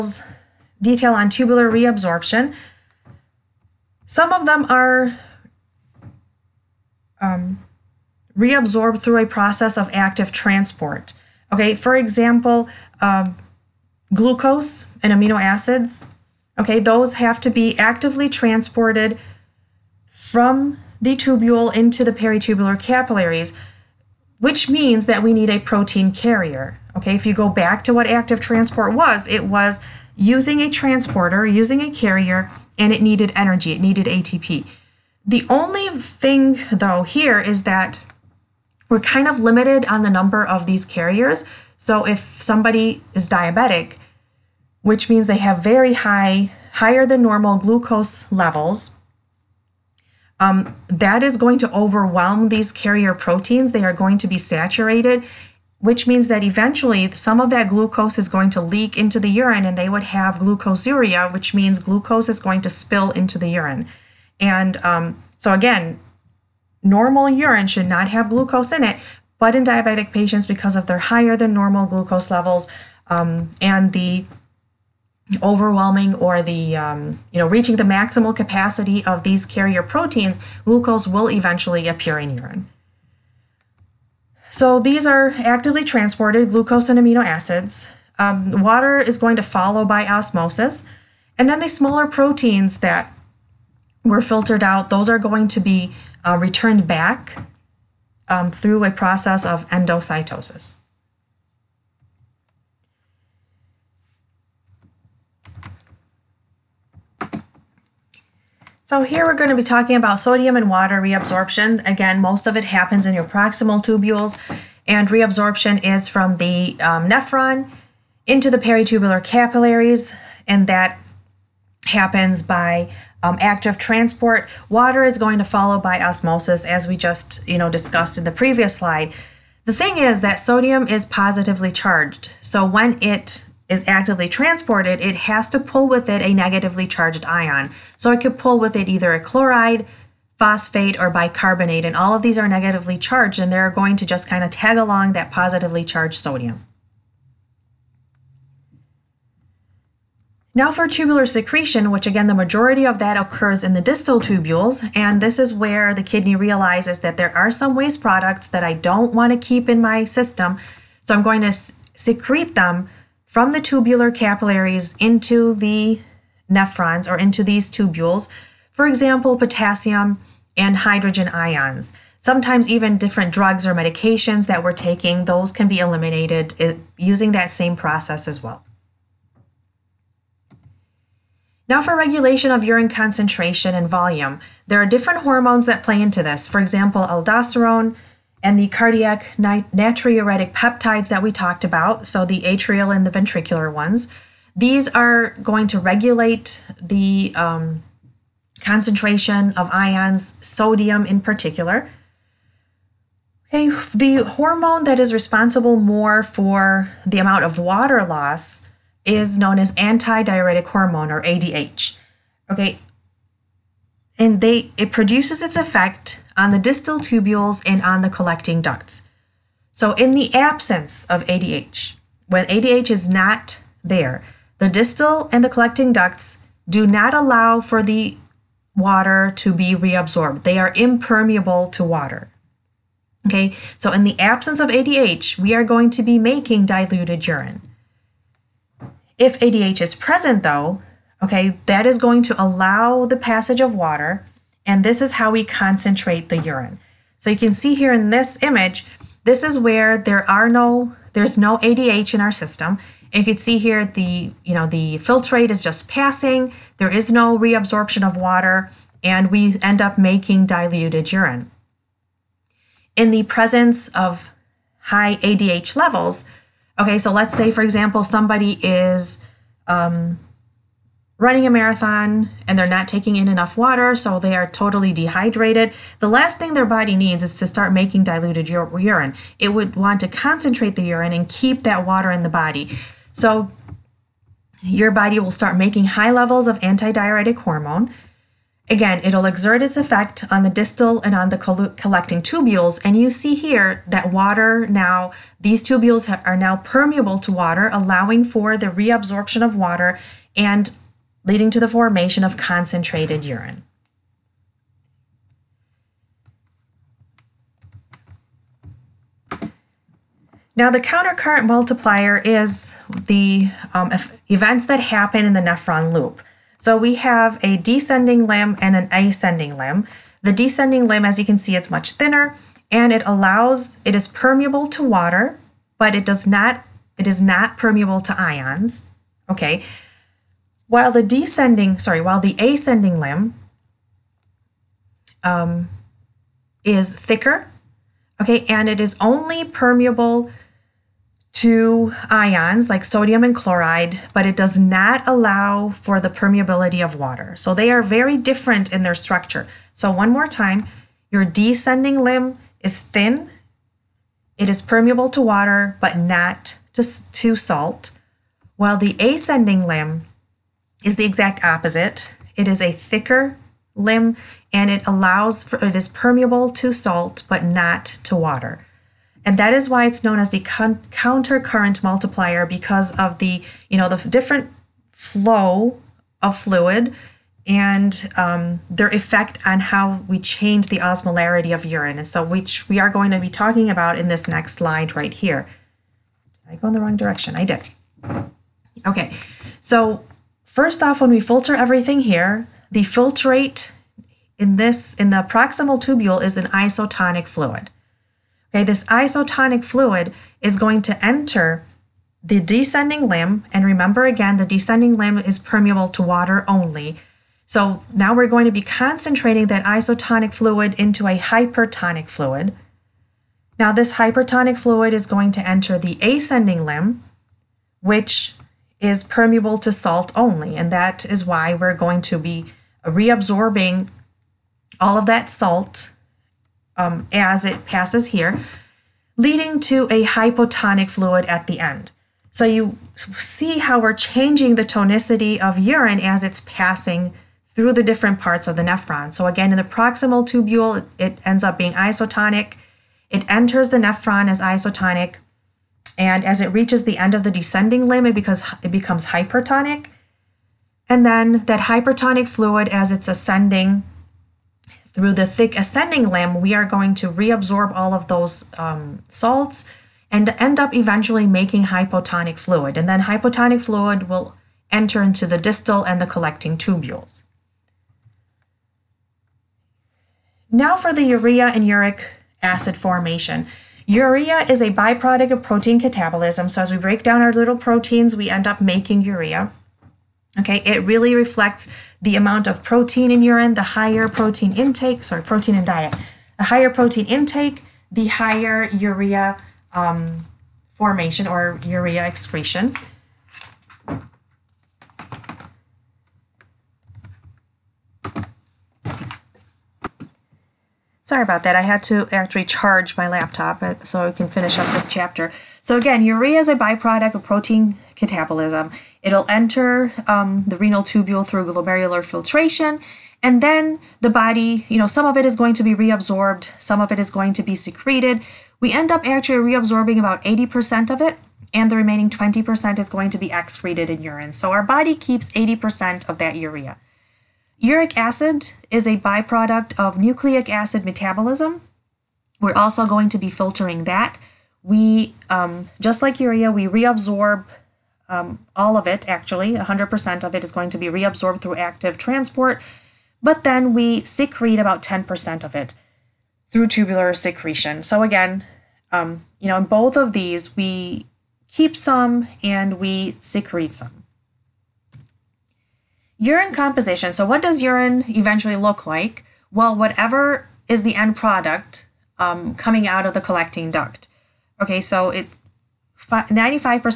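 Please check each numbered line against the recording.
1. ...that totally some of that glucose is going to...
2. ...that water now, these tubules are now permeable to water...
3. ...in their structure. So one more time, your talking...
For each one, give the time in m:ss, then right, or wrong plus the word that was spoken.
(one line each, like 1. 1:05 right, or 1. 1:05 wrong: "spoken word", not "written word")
1. 0:56 wrong: "eventually", not "totally"
2. 4:53 right
3. 5:48 wrong: "descending", not "talking".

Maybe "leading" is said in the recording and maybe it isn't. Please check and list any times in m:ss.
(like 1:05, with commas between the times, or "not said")
5:01, 7:09.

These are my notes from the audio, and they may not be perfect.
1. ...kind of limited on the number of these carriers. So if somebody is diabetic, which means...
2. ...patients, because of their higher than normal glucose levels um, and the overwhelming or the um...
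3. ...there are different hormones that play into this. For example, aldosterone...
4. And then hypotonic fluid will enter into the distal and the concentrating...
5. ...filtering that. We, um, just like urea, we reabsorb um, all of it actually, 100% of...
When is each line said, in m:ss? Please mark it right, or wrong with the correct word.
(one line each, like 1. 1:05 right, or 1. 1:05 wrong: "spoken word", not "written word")
1. 0:38 right
2. 1:10 right
3. 3:04 right
4. 7:42 wrong: "collecting", not "concentrating"
5. 8:53 right.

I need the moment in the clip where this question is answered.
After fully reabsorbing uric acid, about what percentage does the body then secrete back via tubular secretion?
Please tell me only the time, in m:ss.
9:04.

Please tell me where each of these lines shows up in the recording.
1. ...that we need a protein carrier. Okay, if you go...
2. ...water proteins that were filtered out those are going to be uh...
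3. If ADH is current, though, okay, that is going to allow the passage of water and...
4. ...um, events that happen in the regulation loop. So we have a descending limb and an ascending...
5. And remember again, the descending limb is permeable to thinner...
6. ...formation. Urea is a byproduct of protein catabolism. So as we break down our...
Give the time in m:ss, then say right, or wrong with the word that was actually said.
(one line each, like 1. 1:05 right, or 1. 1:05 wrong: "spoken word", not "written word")
1. 0:25 right
2. 1:31 wrong: "smaller", not "water"
3. 3:59 wrong: "present", not "current"
4. 5:13 wrong: "nephron", not "regulation"
5. 6:43 wrong: "water", not "thinner"
6. 7:52 right.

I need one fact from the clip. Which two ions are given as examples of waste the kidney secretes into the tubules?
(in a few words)
potassium and hydrogen.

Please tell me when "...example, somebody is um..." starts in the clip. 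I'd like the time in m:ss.
4:27.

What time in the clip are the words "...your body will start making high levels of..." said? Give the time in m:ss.
4:44.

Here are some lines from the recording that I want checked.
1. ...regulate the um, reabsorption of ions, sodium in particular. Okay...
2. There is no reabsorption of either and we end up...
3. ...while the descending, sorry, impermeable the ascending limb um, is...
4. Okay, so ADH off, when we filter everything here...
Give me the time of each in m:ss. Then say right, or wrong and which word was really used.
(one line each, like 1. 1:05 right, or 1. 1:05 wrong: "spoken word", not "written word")
1. 3:15 wrong: "concentration", not "reabsorption"
2. 4:16 wrong: "water", not "either"
3. 5:30 wrong: "while", not "impermeable"
4. 6:28 wrong: "First", not "ADH".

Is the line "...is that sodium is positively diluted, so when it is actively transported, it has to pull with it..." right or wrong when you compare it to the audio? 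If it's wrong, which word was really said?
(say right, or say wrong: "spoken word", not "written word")
wrong: "charged", not "diluted".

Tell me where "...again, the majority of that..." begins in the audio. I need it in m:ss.
2:32.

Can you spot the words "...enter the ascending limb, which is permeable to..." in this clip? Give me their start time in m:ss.
6:55.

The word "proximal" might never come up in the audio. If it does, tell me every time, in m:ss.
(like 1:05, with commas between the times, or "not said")
1:53, 6:35, 7:19.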